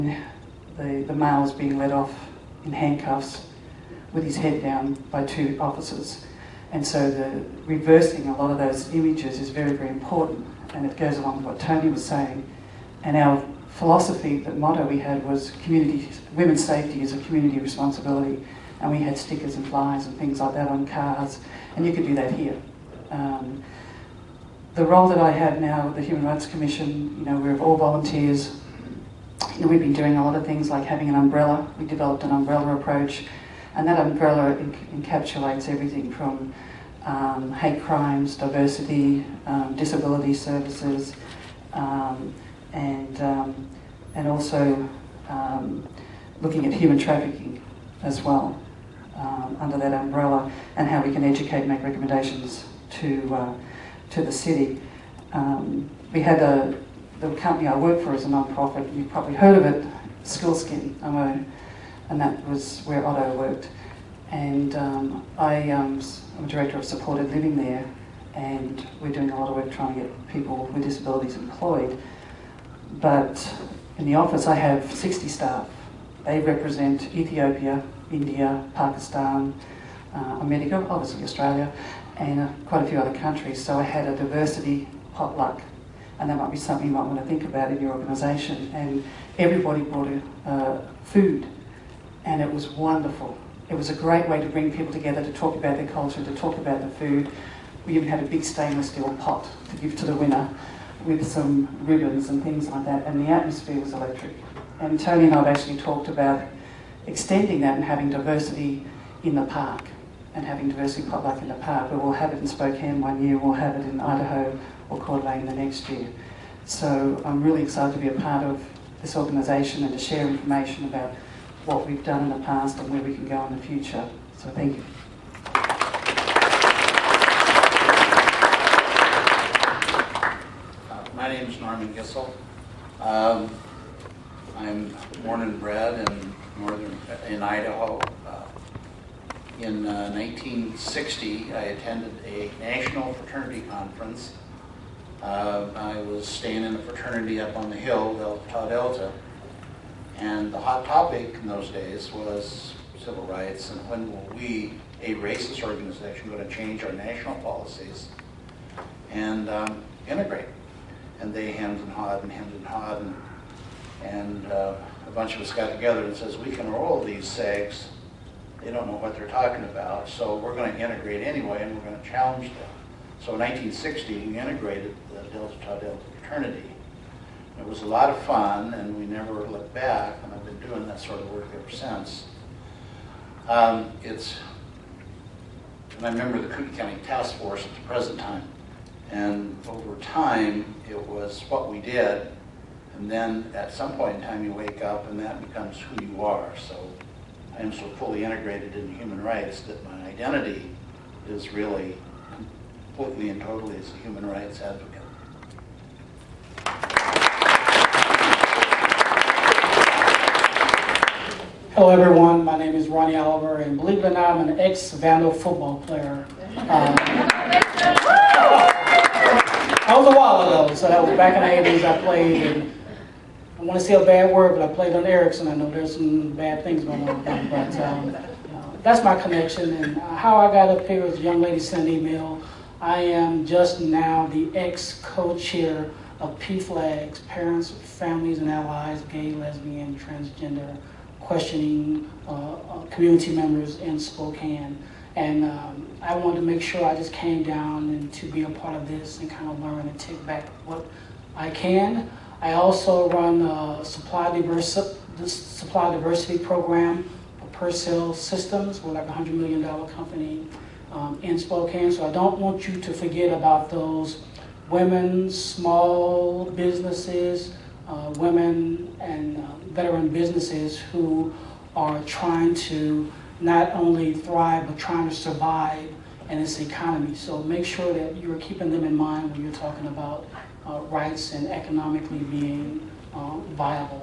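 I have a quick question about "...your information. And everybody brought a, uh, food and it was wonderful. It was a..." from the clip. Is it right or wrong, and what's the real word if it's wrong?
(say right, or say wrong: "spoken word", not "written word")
wrong: "organisation", not "information".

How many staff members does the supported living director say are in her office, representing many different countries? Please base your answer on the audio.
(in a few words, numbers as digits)
60.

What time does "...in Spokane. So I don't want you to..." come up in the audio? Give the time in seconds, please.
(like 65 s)
261 s.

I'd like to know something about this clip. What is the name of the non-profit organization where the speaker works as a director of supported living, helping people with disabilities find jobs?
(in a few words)
Skils'kin.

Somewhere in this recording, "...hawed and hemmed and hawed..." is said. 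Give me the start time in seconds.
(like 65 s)
161 s.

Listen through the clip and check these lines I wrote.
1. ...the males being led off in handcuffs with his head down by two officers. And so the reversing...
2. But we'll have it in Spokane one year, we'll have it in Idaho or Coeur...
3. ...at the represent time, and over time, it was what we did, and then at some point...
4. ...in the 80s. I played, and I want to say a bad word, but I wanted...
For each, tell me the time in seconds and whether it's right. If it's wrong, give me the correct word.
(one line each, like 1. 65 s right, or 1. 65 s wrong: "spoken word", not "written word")
1. 1 s right
2. 111 s right
3. 187 s wrong: "present", not "represent"
4. 221 s wrong: "played", not "wanted".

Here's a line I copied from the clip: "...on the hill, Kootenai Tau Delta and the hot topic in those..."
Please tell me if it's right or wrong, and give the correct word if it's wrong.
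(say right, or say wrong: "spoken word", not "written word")
wrong: "Delta", not "Kootenai".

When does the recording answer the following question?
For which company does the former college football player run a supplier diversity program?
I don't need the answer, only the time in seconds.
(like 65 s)
257 s.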